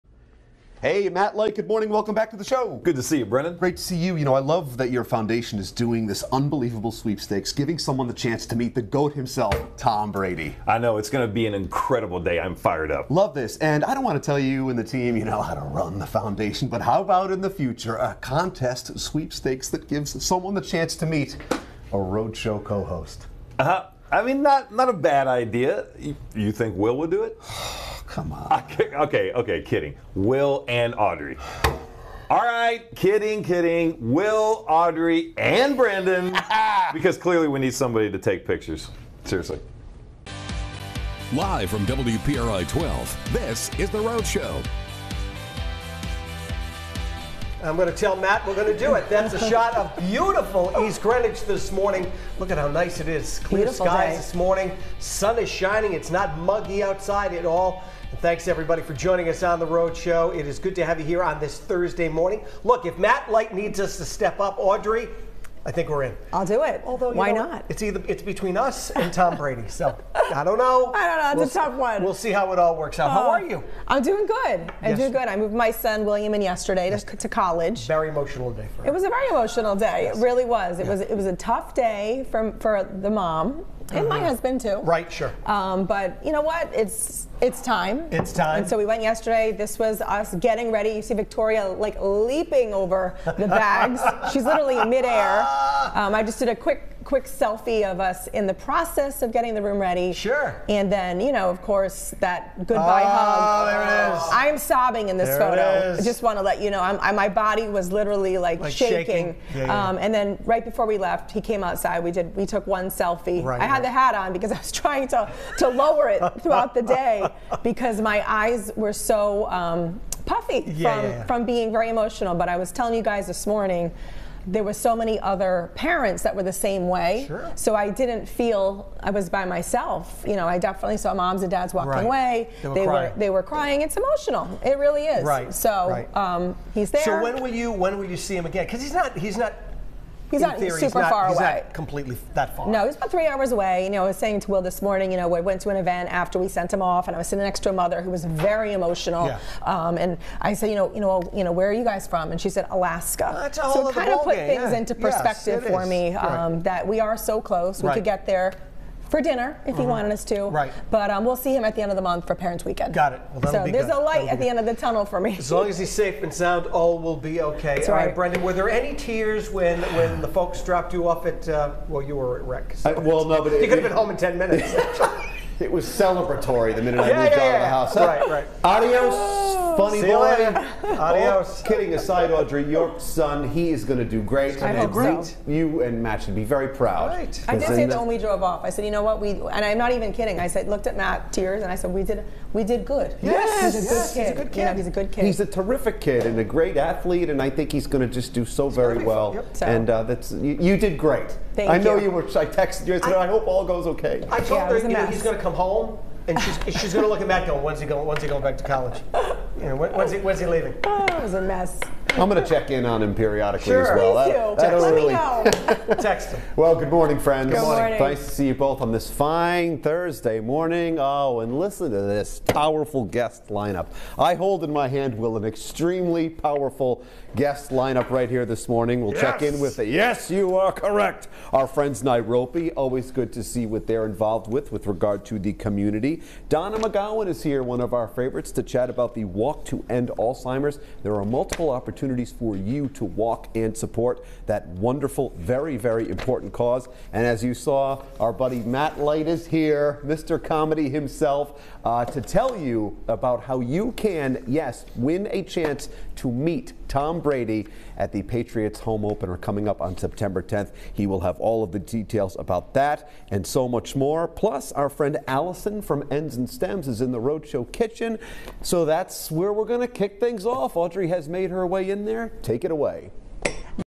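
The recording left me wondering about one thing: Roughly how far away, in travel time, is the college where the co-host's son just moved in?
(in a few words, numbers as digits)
3 hours.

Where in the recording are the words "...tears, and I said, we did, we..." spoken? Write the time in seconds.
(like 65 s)
191 s.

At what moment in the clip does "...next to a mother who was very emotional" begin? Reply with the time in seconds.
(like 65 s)
147 s.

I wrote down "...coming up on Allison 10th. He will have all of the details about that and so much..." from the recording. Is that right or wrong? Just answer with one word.
wrong.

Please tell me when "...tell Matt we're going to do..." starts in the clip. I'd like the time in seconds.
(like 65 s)
47 s.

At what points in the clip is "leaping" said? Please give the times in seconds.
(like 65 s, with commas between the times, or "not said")
92 s.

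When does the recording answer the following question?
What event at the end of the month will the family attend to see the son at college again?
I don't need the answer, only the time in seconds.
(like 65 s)
162 s.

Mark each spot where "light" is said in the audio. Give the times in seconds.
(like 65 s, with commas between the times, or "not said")
1 s, 63 s, 163 s, 248 s.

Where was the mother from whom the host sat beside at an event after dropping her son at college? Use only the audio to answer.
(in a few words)
Alaska.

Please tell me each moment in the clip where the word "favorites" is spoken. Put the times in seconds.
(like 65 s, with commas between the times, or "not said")
238 s.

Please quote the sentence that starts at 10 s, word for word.
I know, it's going to be an incredible day.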